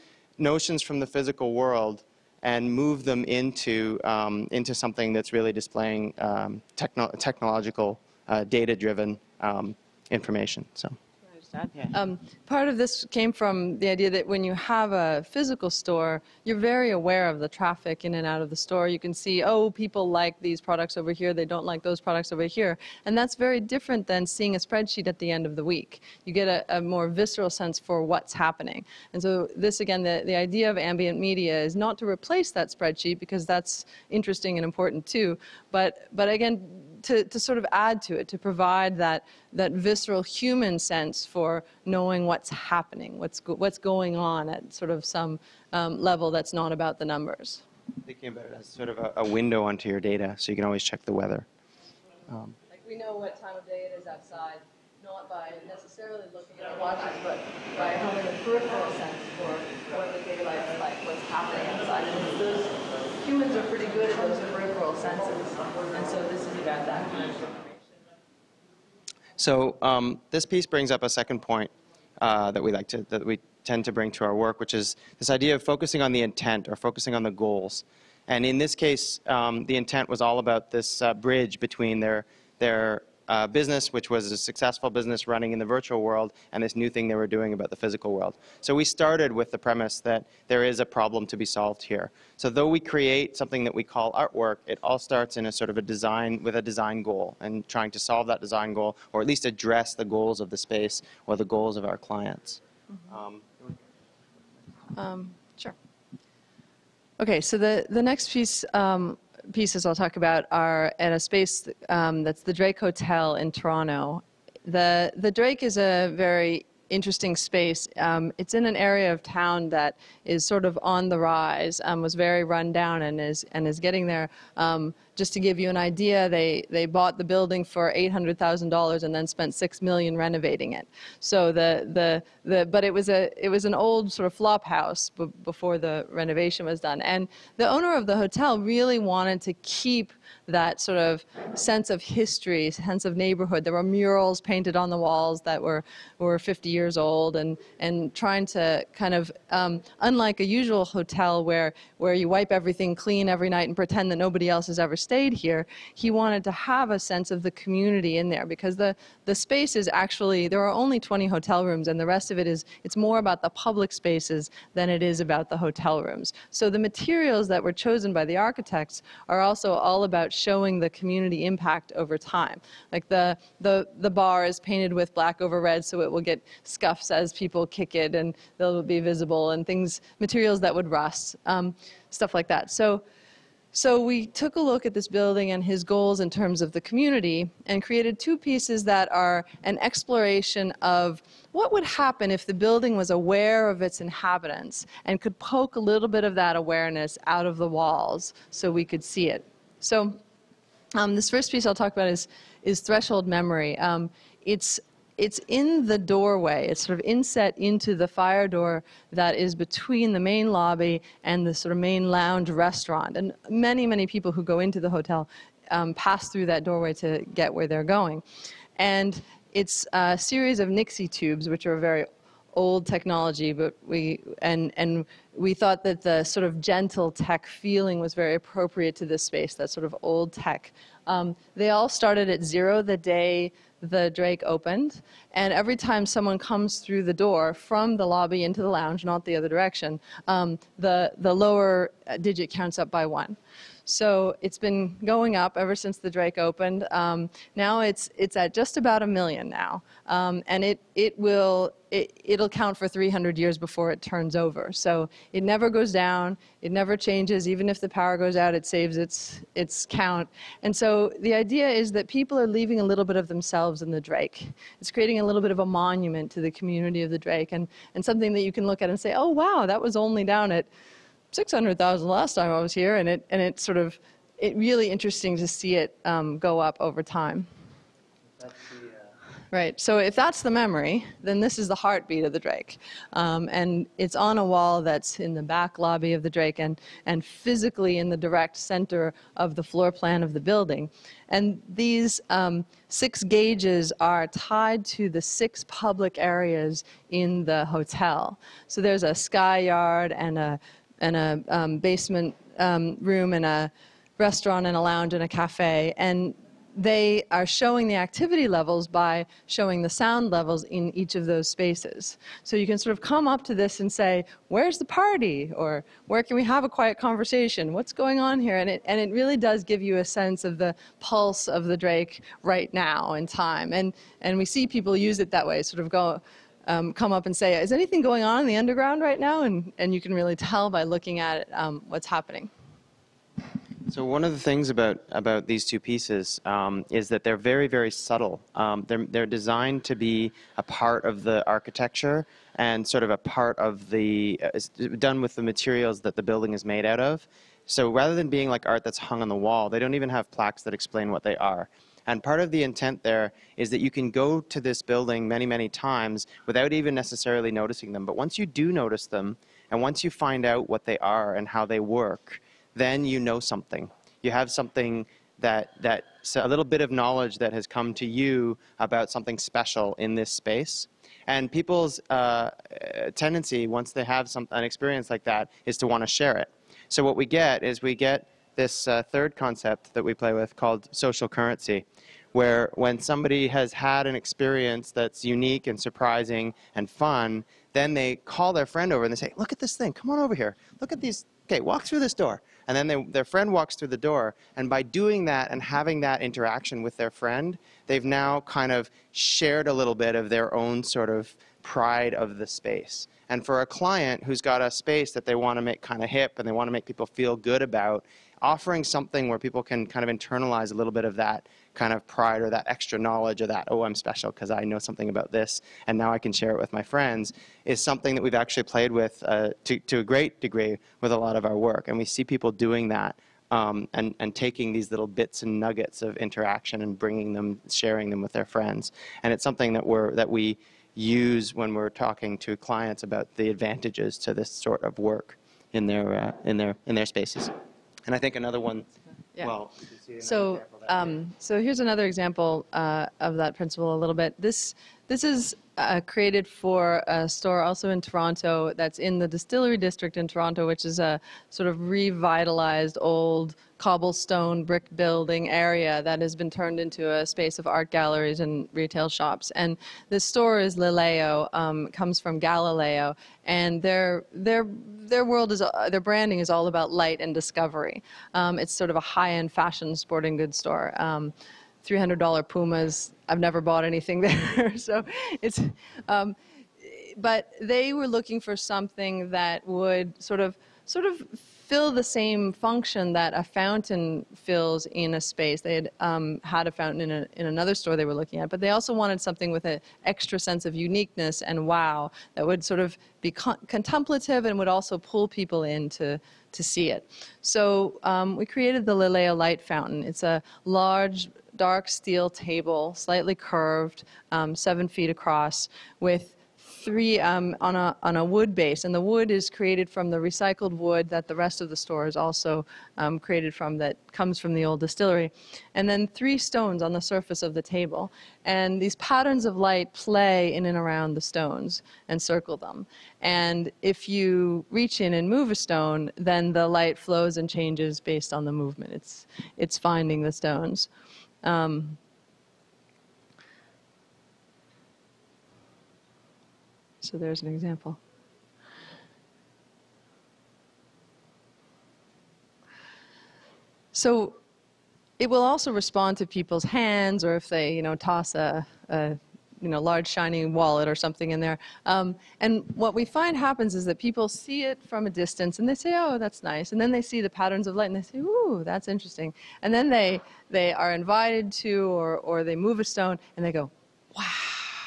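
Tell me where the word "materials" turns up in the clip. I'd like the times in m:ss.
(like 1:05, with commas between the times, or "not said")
2:46, 3:00, 5:45.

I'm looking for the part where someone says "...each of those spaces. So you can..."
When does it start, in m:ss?
5:10.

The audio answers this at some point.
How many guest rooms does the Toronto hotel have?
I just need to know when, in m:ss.
2:40.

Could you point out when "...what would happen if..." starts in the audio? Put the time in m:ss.
3:11.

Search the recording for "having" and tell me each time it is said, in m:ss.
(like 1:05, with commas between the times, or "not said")
0:57, 6:35.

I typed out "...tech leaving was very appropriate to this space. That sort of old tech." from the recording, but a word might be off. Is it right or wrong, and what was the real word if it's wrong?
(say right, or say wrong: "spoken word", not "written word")
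wrong: "feeling", not "leaving".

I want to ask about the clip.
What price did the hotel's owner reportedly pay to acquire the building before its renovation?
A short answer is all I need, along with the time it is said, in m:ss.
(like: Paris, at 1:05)
$800,000, at 2:07.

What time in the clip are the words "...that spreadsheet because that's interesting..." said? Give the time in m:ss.
0:32.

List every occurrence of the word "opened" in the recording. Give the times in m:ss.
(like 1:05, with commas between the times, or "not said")
3:54, 4:06.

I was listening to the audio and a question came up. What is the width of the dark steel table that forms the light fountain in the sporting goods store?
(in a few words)
7 feet.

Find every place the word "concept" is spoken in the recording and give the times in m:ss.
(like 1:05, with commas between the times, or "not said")
6:19.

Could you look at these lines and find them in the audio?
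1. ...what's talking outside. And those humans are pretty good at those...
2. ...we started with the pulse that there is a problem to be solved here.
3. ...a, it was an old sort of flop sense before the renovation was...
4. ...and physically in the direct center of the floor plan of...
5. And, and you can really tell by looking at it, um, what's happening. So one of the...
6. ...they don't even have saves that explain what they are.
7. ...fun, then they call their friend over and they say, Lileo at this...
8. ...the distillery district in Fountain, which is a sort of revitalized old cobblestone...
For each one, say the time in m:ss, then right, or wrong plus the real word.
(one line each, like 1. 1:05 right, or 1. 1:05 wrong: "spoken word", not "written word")
1. 1:01 wrong: "happening", not "talking"
2. 1:28 wrong: "premise", not "pulse"
3. 2:13 wrong: "house", not "sense"
4. 4:47 right
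5. 5:29 right
6. 5:49 wrong: "plaques", not "saves"
7. 6:26 wrong: "Look", not "Lileo"
8. 7:29 wrong: "Toronto", not "Fountain".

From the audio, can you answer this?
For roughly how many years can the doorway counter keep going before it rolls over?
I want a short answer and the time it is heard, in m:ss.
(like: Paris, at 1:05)
300 years, at 4:12.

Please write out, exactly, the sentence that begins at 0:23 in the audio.
And that's very different than seeing a spreadsheet at the end of the week.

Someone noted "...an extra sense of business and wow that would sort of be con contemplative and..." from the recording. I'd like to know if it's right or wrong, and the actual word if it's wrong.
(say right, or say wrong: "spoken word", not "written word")
wrong: "uniqueness", not "business".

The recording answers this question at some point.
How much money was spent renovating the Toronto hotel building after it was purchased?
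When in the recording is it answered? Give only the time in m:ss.
2:09.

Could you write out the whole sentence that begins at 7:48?
Um, it's sort of a high-end fashion sporting goods store.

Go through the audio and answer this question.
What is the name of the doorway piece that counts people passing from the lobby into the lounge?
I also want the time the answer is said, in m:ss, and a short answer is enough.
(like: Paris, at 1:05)
Threshold Memory, at 3:22.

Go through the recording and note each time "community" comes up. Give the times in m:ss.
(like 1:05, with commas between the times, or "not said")
2:37, 2:50, 3:06, 4:26.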